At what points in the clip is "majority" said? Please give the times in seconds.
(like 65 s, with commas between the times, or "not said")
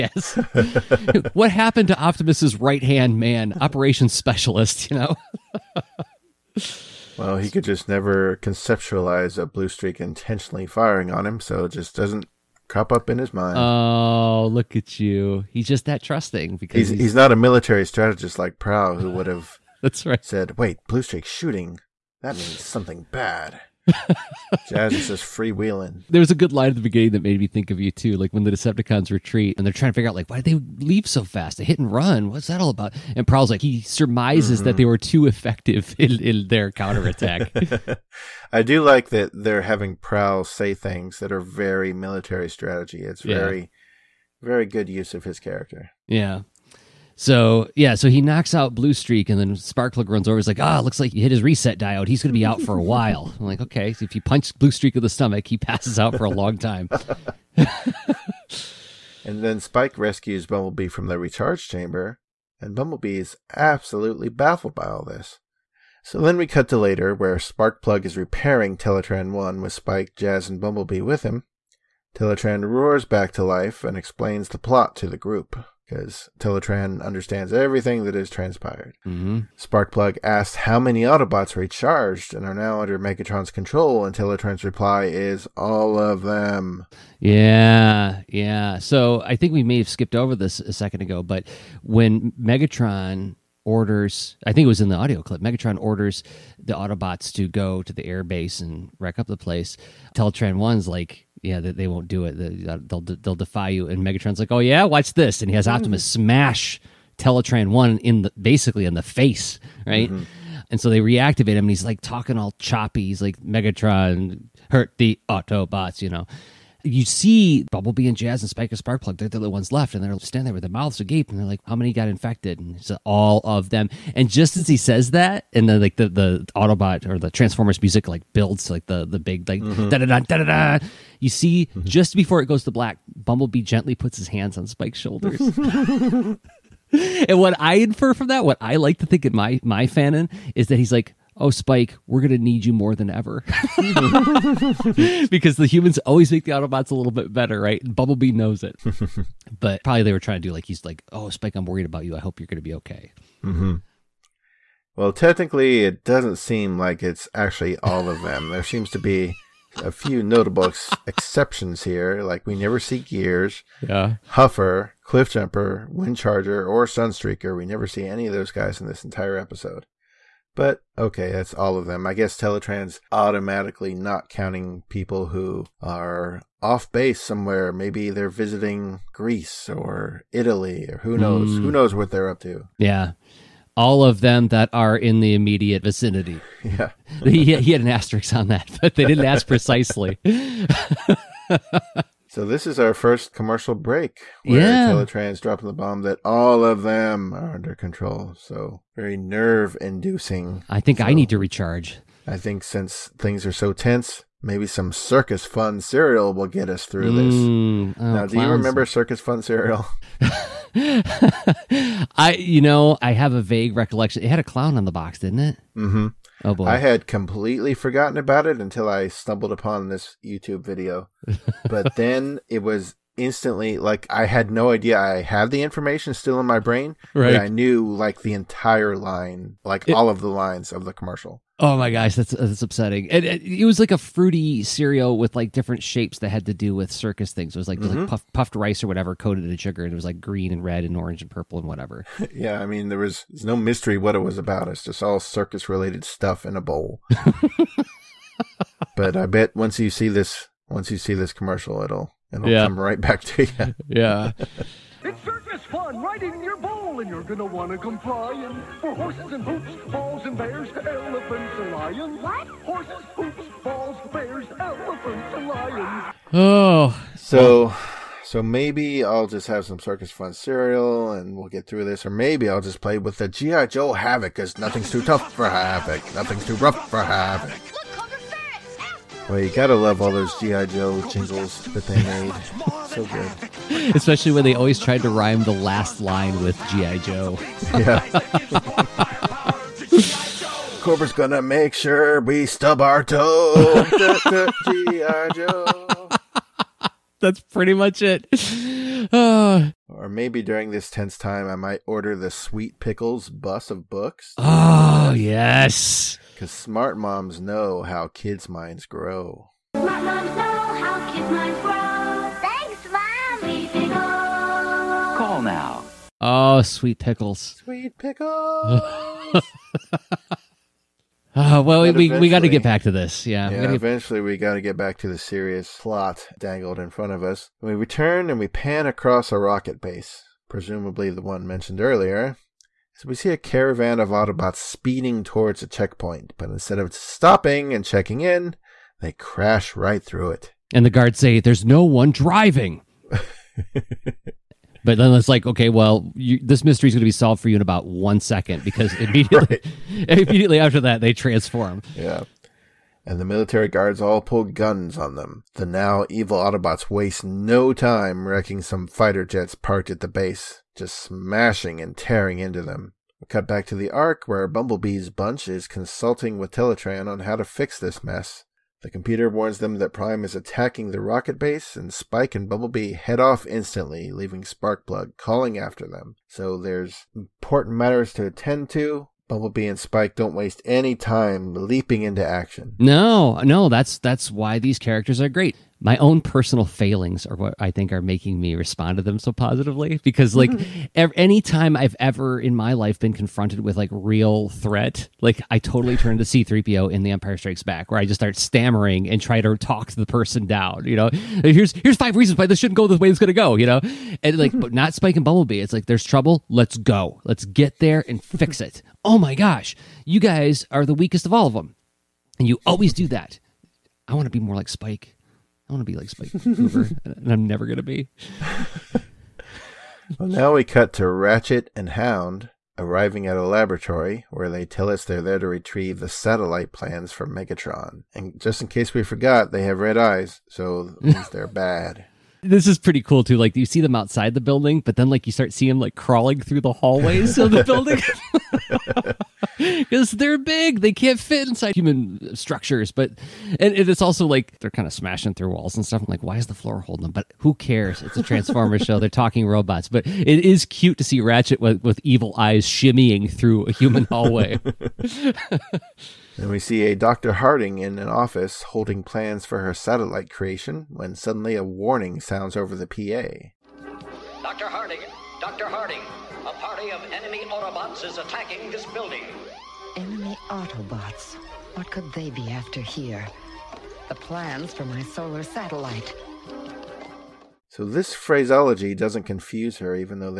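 not said.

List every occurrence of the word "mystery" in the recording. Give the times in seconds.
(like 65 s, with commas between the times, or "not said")
243 s, 346 s.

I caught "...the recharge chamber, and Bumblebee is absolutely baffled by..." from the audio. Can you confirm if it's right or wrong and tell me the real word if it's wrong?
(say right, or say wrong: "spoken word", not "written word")
right.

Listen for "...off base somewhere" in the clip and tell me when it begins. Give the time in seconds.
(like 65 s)
176 s.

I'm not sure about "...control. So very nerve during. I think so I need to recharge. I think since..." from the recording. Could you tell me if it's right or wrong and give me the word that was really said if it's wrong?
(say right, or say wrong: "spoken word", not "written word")
wrong: "inducing", not "during".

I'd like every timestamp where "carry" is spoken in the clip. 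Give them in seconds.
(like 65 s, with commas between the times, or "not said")
not said.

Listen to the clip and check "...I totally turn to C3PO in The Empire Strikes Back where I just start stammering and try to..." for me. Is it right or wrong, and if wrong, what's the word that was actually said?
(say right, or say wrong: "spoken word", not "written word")
right.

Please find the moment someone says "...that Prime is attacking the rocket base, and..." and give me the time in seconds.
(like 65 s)
369 s.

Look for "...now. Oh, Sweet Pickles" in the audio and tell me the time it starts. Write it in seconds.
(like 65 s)
315 s.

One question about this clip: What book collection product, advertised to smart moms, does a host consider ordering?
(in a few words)
Sweet Pickles bus of books.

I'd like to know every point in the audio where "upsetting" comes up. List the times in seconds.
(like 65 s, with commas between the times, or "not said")
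232 s.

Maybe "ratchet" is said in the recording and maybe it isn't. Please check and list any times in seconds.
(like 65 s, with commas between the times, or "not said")
421 s, 451 s.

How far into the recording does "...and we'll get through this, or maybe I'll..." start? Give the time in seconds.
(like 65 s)
271 s.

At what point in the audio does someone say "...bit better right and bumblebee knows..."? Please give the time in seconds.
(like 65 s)
147 s.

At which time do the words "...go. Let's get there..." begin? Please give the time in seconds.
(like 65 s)
406 s.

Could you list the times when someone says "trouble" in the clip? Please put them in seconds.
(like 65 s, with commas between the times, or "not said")
406 s.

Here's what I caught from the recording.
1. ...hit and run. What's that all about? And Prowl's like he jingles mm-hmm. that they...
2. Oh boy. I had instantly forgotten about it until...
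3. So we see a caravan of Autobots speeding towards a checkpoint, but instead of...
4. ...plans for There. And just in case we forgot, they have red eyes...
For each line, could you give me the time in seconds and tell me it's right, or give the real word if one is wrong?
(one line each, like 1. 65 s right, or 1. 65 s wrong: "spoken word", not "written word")
1. 31 s wrong: "surmises", not "jingles"
2. 216 s wrong: "completely", not "instantly"
3. 332 s right
4. 426 s wrong: "Megatron", not "There".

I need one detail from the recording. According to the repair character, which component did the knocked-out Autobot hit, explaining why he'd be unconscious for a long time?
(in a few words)
reset diode.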